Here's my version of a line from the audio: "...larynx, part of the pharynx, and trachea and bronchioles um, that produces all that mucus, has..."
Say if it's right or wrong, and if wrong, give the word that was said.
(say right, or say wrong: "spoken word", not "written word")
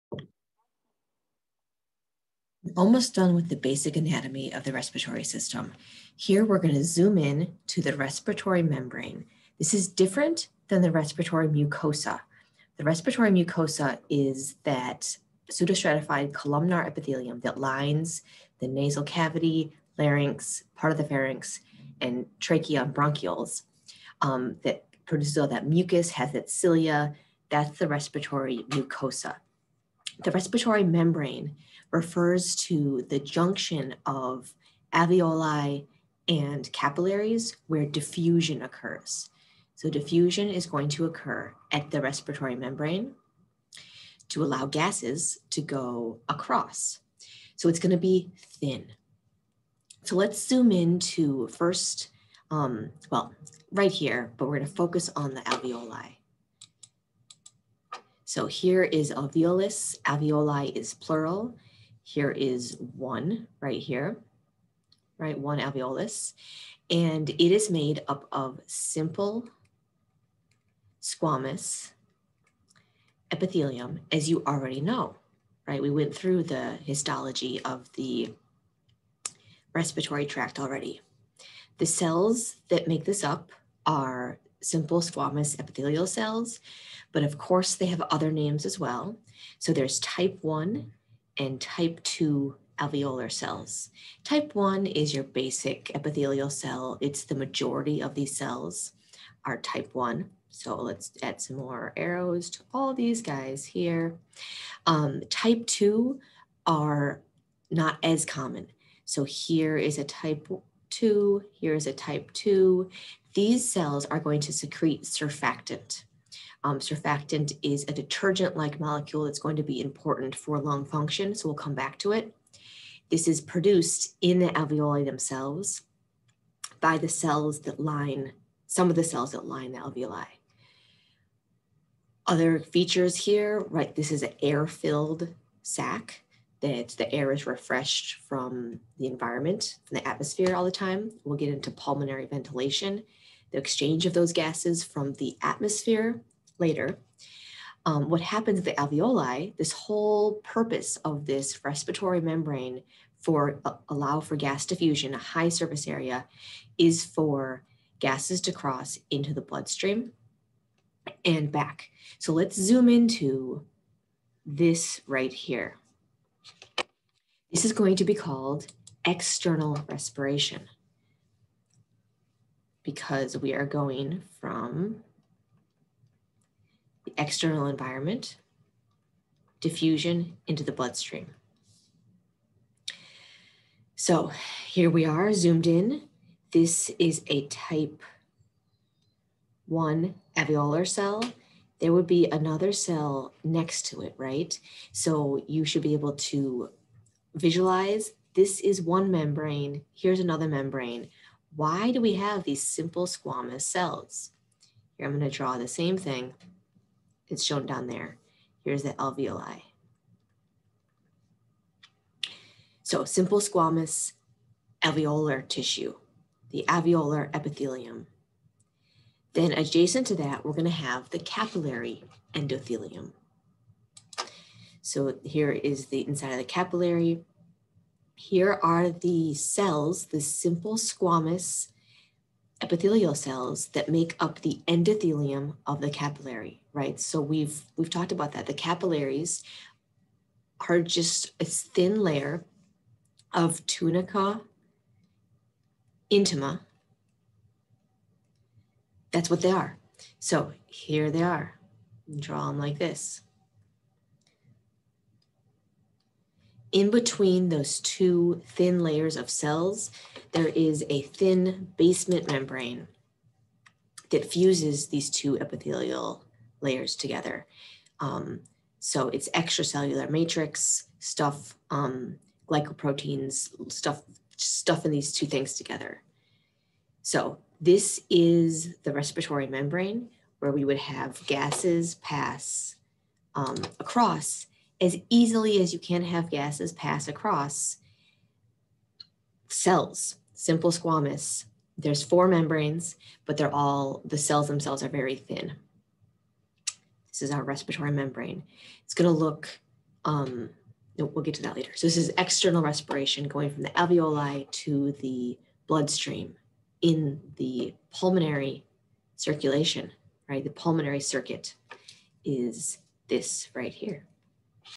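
right.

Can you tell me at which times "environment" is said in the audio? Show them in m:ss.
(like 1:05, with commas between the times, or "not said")
2:19, 2:57.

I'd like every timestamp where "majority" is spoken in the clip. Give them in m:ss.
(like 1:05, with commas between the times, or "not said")
1:37.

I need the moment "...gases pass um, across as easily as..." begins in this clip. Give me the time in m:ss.
4:41.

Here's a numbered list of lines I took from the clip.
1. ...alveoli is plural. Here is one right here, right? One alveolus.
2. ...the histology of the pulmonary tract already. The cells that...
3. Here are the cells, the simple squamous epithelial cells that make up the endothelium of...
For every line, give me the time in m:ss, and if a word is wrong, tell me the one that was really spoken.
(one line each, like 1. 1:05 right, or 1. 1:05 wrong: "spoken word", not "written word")
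1. 1:00 right
2. 1:16 wrong: "respiratory", not "pulmonary"
3. 3:48 right.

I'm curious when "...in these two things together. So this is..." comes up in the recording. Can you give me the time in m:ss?
4:34.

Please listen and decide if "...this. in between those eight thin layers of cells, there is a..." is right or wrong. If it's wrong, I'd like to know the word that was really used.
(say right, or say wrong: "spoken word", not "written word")
wrong: "two", not "eight".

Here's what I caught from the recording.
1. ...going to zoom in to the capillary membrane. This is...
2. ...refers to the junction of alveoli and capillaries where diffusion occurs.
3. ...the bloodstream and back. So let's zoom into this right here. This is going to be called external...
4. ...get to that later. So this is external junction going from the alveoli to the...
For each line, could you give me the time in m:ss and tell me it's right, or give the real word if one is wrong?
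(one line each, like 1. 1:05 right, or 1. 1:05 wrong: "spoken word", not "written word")
1. 0:06 wrong: "respiratory", not "capillary"
2. 0:31 right
3. 2:39 right
4. 5:01 wrong: "respiration", not "junction".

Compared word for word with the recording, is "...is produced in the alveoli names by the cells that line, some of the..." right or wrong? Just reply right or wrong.
wrong.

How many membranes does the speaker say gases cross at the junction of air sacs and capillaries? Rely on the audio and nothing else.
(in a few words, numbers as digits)
4.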